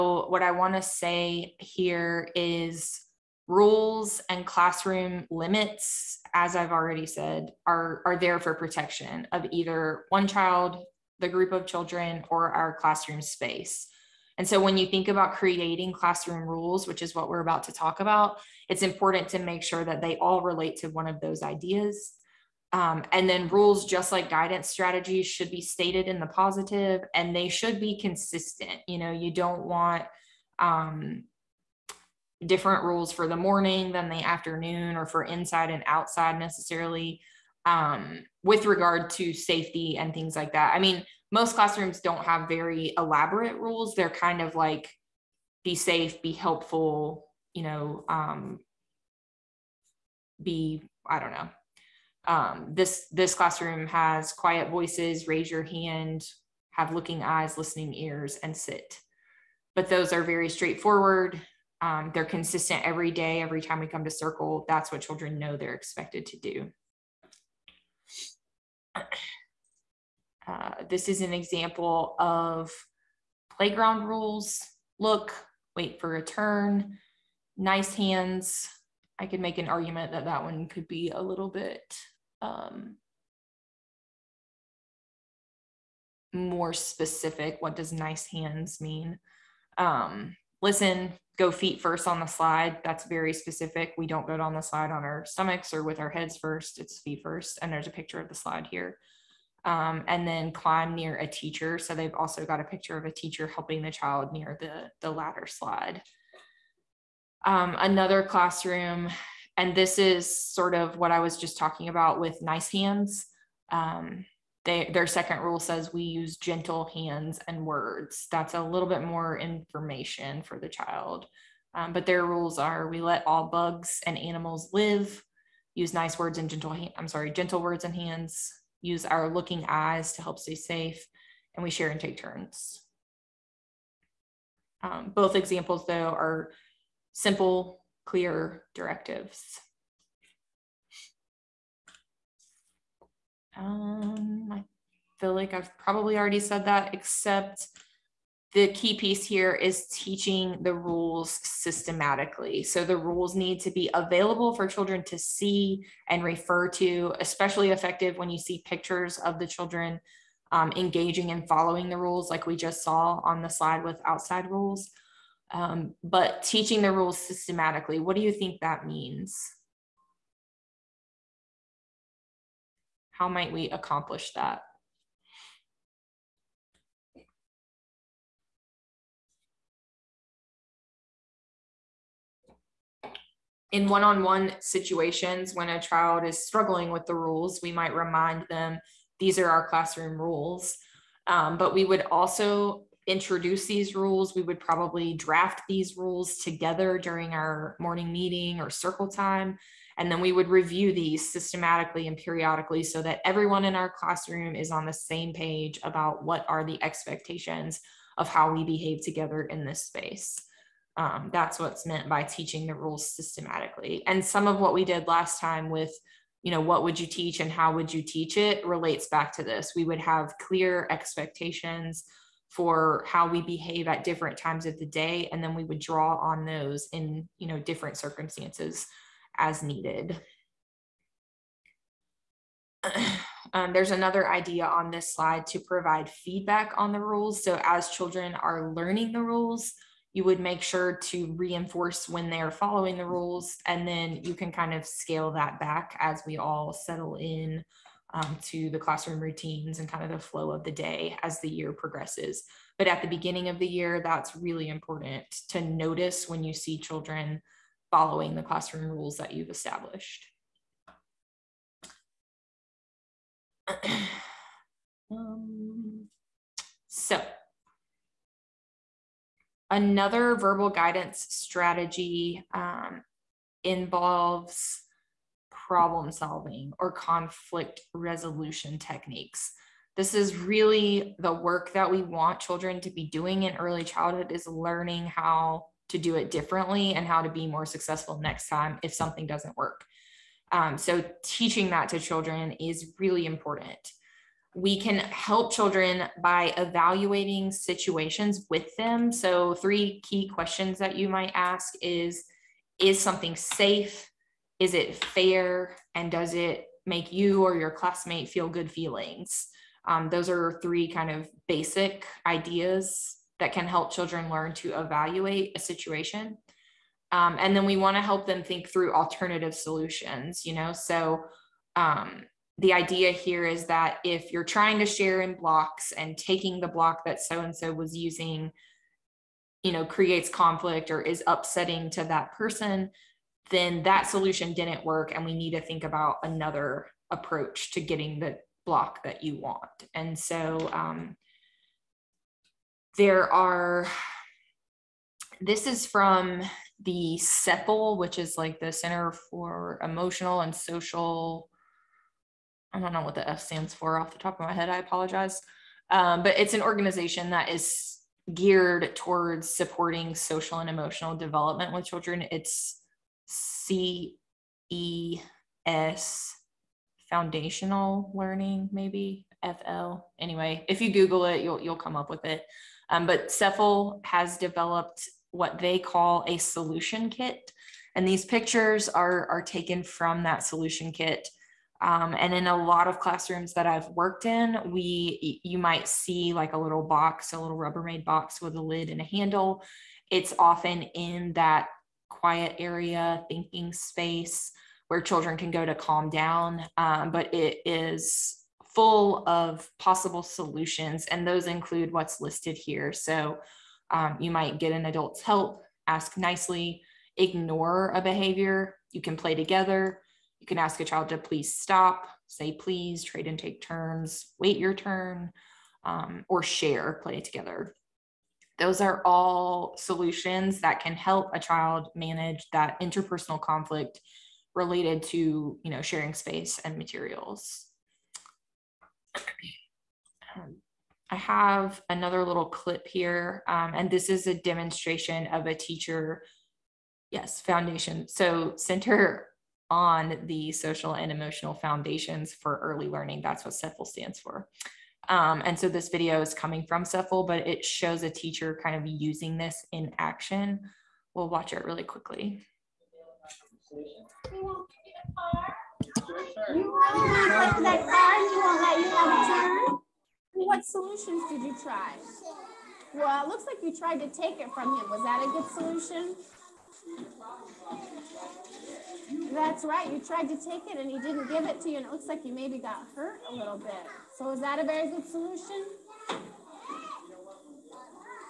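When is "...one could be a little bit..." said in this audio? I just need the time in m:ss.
1:20.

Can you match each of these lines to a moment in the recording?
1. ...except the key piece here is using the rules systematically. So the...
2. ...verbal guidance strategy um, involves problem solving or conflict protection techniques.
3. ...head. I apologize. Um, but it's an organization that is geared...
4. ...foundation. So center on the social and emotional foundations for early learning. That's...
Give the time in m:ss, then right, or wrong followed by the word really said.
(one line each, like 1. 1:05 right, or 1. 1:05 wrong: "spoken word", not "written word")
1. 2:26 wrong: "teaching", not "using"
2. 4:30 wrong: "resolution", not "protection"
3. 5:54 right
4. 7:17 right.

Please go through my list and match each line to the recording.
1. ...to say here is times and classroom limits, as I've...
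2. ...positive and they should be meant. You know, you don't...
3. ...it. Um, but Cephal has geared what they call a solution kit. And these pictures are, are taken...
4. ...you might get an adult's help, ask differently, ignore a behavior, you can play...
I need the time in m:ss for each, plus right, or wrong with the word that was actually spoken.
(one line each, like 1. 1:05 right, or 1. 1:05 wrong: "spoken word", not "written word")
1. 0:00 wrong: "rules", not "times"
2. 0:26 wrong: "consistent", not "meant"
3. 6:12 wrong: "developed", not "geared"
4. 6:44 wrong: "nicely", not "differently".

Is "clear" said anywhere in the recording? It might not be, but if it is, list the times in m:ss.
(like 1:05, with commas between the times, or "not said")
2:18, 3:40.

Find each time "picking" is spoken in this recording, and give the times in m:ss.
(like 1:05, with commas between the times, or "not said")
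not said.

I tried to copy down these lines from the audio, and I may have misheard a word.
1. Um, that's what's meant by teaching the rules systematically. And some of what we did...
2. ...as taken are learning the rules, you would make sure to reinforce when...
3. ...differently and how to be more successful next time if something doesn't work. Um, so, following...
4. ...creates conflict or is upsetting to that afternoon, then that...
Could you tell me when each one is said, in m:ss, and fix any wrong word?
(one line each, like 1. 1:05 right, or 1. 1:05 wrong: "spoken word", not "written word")
1. 3:30 right
2. 3:57 wrong: "children", not "taken"
3. 4:46 wrong: "teaching", not "following"
4. 5:29 wrong: "person", not "afternoon".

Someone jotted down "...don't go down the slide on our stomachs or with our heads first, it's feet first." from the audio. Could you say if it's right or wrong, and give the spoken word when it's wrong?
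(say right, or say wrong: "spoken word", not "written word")
right.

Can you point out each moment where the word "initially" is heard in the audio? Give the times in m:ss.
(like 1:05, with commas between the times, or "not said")
not said.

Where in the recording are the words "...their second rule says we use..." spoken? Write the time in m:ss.
1:54.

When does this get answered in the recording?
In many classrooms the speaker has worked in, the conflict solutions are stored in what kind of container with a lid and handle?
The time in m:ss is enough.
6:27.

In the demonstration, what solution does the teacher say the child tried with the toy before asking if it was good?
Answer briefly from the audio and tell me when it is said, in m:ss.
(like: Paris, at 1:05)
Take it from him, at 7:44.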